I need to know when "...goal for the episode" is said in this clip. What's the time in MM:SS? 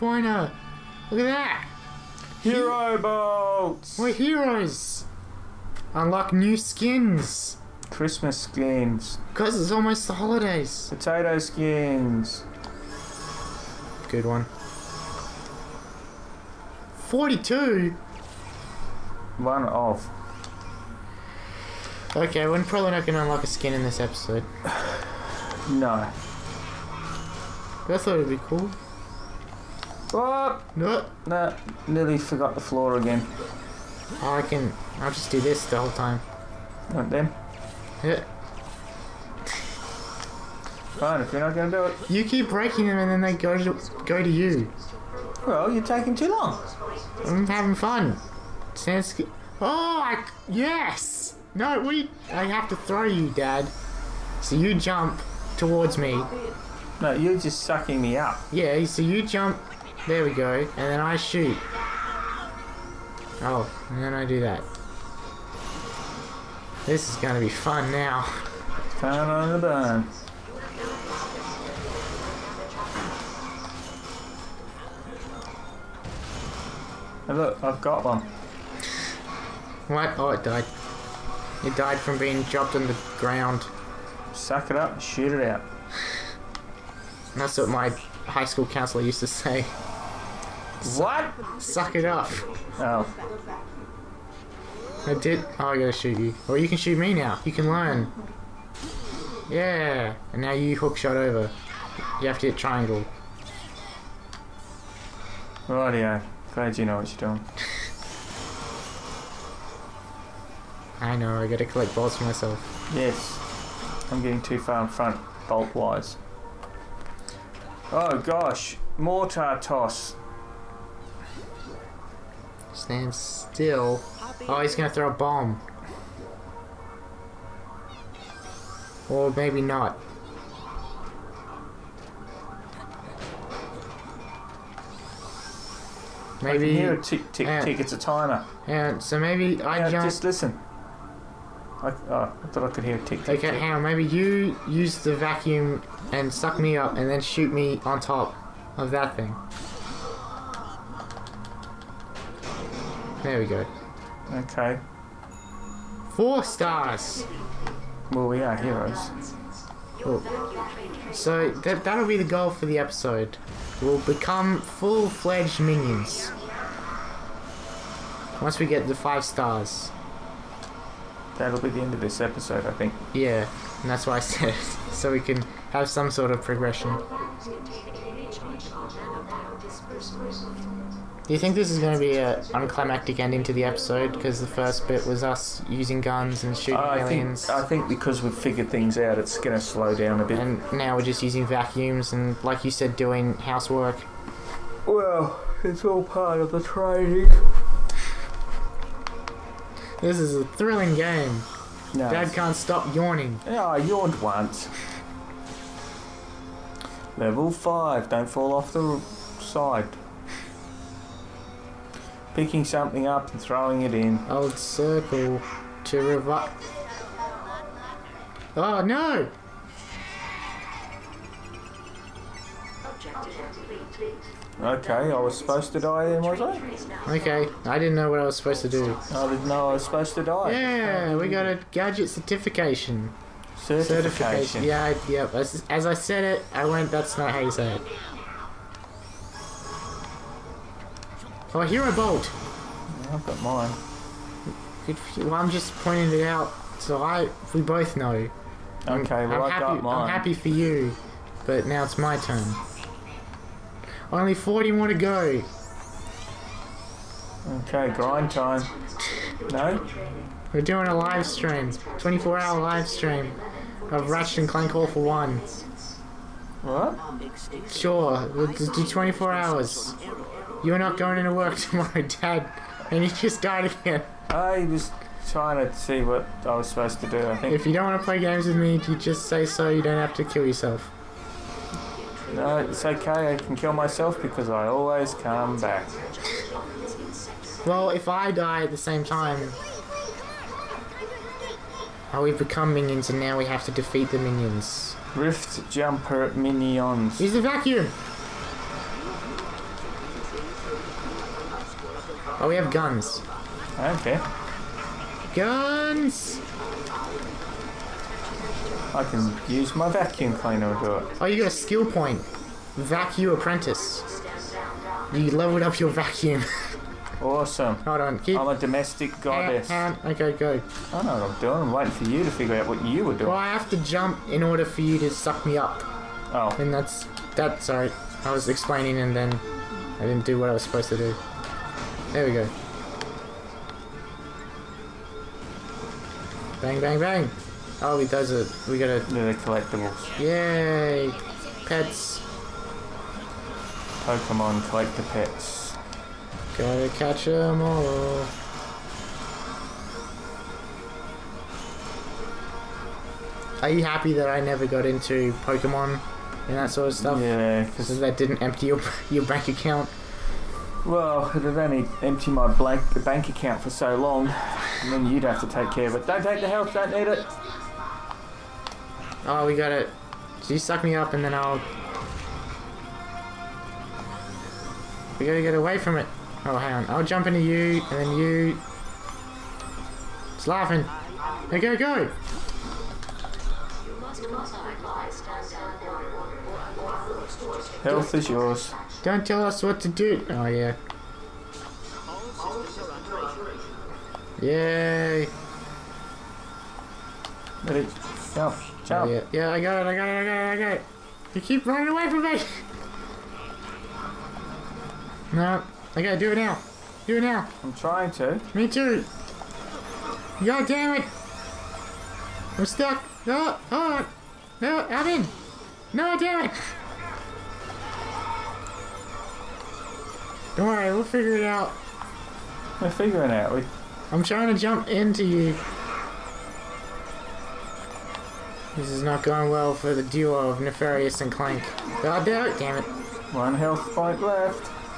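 02:42.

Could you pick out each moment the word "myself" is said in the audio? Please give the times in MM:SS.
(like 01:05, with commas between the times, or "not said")
01:52, 04:43.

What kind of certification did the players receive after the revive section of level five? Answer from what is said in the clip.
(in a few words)
Gadget certification.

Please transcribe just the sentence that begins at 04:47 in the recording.
Well, if I die at the same time...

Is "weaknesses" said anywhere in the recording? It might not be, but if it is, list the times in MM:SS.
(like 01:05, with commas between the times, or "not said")
not said.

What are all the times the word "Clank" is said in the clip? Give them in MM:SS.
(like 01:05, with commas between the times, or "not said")
04:24, 07:11.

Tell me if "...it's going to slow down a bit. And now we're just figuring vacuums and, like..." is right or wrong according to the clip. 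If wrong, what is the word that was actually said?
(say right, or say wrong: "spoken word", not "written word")
wrong: "using", not "figuring".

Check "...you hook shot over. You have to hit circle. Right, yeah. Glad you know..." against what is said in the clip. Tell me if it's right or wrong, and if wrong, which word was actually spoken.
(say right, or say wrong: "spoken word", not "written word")
wrong: "triangle", not "circle".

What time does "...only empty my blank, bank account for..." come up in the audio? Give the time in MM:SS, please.
06:01.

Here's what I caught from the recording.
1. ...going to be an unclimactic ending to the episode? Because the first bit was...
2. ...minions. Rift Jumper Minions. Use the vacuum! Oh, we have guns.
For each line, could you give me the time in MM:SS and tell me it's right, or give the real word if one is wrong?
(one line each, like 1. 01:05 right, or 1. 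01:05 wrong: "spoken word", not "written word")
1. 03:01 right
2. 04:54 right.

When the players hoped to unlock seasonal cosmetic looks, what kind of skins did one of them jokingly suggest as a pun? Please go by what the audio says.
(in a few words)
Potato skins.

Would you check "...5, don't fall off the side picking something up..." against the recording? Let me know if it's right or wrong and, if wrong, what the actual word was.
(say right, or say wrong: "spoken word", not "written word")
right.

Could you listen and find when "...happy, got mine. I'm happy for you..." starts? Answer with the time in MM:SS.
04:09.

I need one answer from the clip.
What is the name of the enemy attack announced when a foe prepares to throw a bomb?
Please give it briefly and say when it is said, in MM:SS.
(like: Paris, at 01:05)
Mortar toss, at 01:58.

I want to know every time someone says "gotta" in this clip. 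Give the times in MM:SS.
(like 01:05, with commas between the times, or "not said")
01:35, 01:51, 05:38, 05:46, 06:15, 06:46.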